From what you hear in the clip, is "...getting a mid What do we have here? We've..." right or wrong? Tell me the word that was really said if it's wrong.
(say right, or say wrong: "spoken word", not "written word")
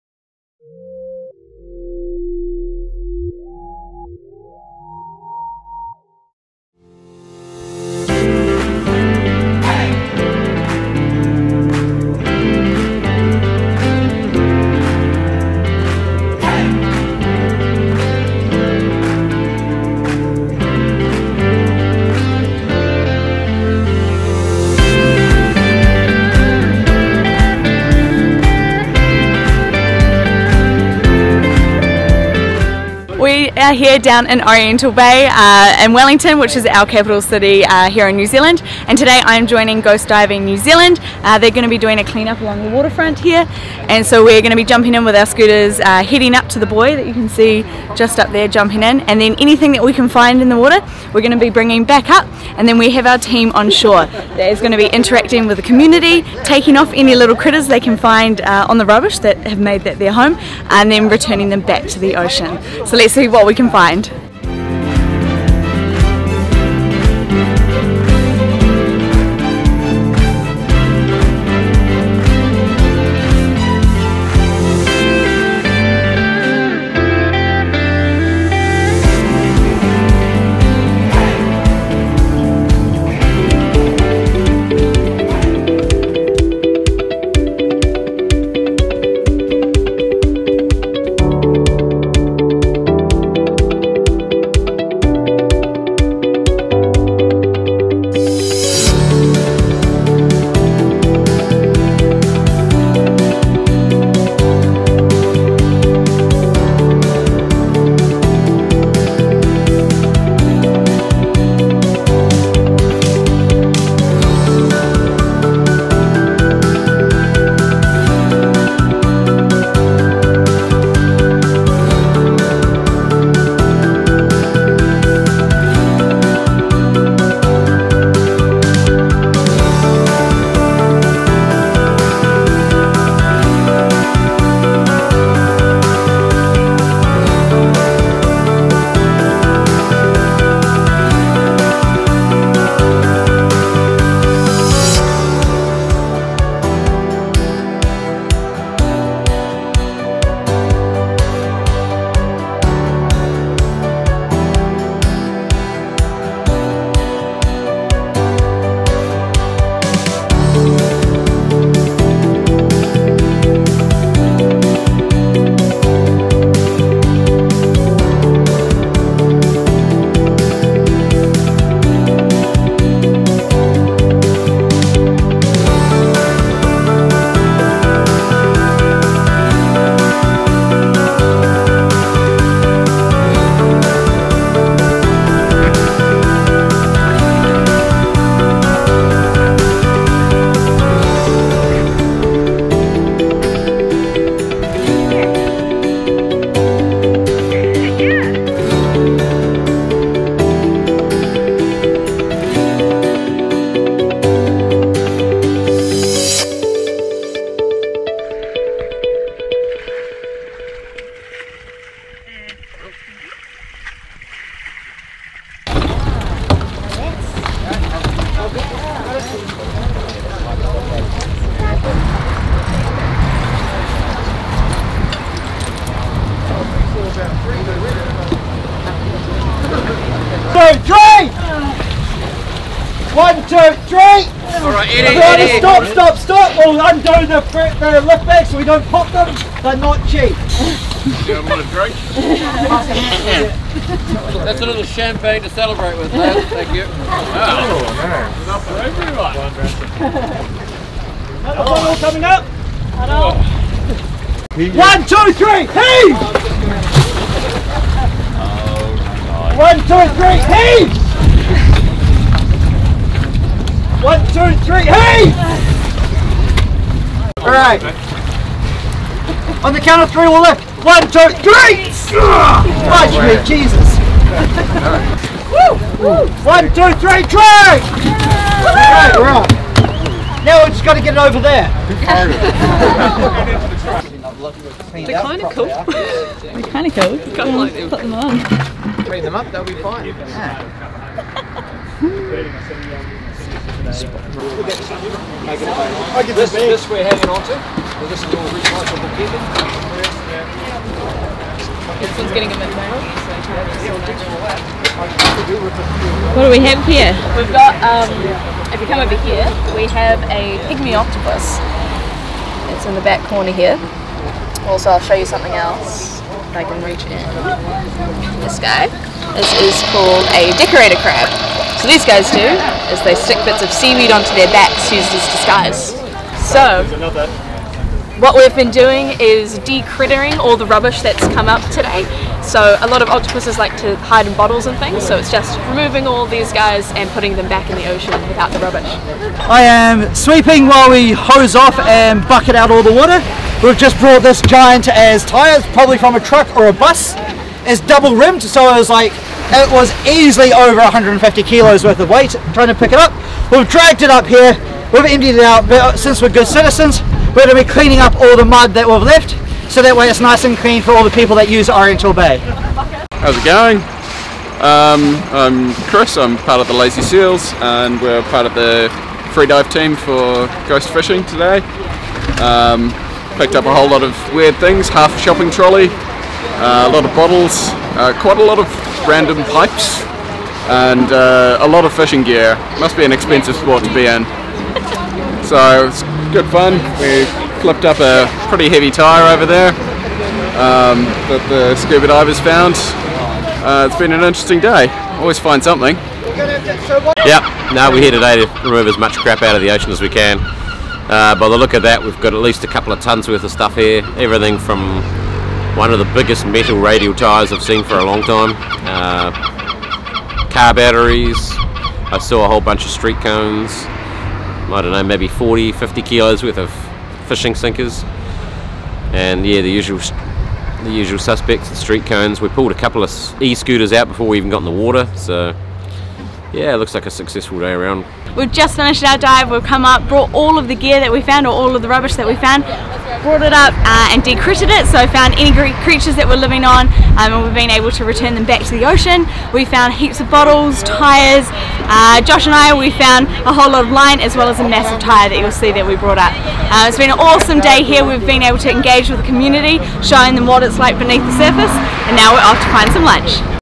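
right.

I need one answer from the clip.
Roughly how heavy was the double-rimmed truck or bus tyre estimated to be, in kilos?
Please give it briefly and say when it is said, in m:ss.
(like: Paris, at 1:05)
over 150 kilos, at 5:50.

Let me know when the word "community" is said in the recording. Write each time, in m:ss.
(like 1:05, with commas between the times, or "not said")
0:55, 7:29.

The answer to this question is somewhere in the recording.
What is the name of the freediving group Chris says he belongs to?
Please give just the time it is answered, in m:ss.
6:06.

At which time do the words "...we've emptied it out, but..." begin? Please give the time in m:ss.
5:54.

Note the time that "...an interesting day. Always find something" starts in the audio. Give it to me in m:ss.
6:34.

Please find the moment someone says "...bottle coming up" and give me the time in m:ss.
4:11.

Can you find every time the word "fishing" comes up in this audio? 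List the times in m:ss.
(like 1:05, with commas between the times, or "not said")
6:10, 6:21, 6:57.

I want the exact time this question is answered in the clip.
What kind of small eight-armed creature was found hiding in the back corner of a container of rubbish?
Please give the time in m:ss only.
5:10.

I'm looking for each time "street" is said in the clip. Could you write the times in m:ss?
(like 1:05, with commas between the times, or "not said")
6:52, 7:01.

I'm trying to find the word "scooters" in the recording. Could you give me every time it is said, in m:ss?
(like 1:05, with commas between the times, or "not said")
0:45, 7:03.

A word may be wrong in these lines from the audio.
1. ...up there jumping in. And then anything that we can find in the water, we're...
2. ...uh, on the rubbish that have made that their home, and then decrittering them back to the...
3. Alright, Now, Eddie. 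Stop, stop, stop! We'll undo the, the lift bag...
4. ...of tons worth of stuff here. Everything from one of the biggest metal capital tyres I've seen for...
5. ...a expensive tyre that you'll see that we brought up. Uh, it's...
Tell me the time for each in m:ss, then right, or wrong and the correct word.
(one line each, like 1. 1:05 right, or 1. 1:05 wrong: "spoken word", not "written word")
1. 0:48 right
2. 0:58 wrong: "returning", not "decrittering"
3. 3:54 wrong: "Eddie", not "Now"
4. 6:42 wrong: "radial", not "capital"
5. 7:24 wrong: "massive", not "expensive".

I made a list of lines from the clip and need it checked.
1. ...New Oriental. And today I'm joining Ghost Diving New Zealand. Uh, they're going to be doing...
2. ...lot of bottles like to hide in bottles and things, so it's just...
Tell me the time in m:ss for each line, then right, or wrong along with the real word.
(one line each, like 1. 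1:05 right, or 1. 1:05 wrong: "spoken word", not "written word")
1. 0:38 wrong: "Zealand", not "Oriental"
2. 5:32 wrong: "octopuses", not "bottles".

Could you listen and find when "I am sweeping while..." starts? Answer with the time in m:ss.
5:39.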